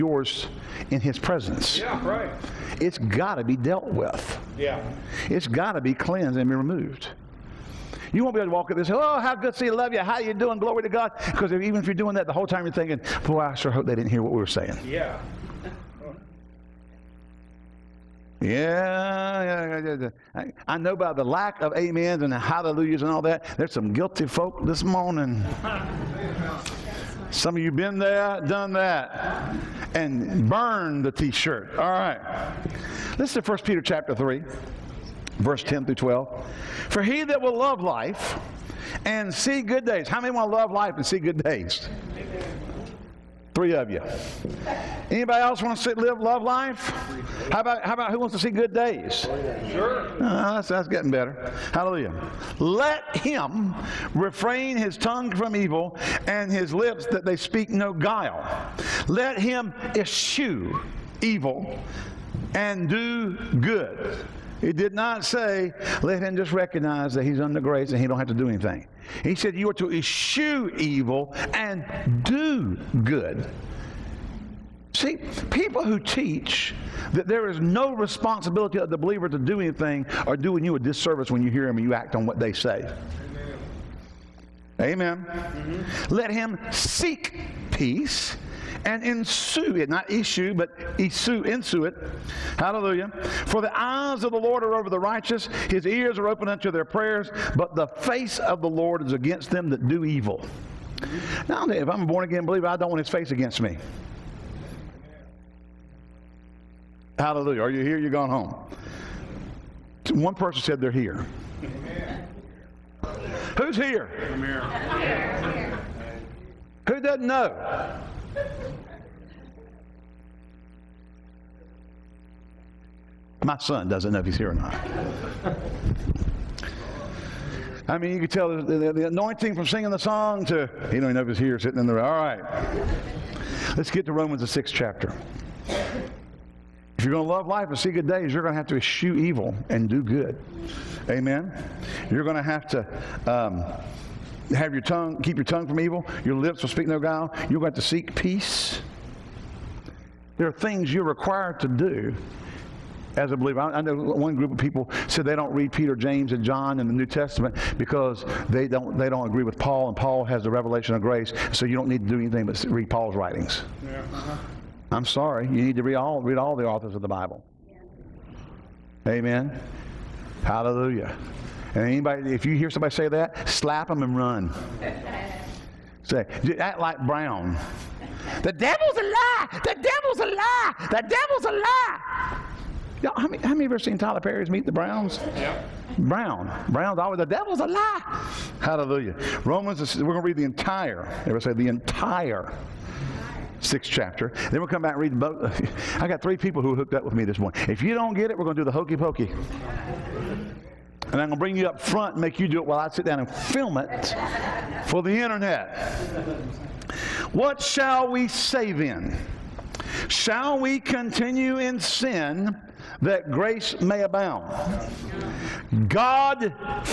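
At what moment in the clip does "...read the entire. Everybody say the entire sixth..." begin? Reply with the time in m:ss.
3:10.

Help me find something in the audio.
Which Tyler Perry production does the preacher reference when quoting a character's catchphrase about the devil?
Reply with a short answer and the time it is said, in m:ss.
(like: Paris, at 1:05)
Meet the Browns, at 3:04.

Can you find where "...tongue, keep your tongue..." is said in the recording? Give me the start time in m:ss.
2:24.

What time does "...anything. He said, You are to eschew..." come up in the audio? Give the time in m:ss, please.
1:08.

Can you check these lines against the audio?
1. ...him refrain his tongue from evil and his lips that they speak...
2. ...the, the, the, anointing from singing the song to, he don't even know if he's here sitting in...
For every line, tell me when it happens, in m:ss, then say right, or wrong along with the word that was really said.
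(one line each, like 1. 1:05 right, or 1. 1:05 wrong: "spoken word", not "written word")
1. 0:53 right
2. 2:08 right.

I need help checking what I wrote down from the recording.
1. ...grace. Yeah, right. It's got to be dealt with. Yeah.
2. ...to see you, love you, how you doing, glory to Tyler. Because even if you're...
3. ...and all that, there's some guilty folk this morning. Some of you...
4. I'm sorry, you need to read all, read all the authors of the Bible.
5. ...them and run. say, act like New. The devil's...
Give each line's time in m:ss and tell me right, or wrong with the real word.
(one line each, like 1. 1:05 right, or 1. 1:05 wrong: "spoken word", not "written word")
1. 0:01 wrong: "presence", not "grace"
2. 0:09 wrong: "God", not "Tyler"
3. 0:23 right
4. 2:44 right
5. 2:53 wrong: "Brown", not "New".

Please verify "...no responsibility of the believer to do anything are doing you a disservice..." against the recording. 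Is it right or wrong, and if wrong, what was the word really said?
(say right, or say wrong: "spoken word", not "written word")
right.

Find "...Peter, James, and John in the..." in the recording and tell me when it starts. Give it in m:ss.
2:35.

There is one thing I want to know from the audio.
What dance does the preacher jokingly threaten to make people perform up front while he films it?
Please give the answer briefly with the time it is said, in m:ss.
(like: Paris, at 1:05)
Hokey pokey, at 3:18.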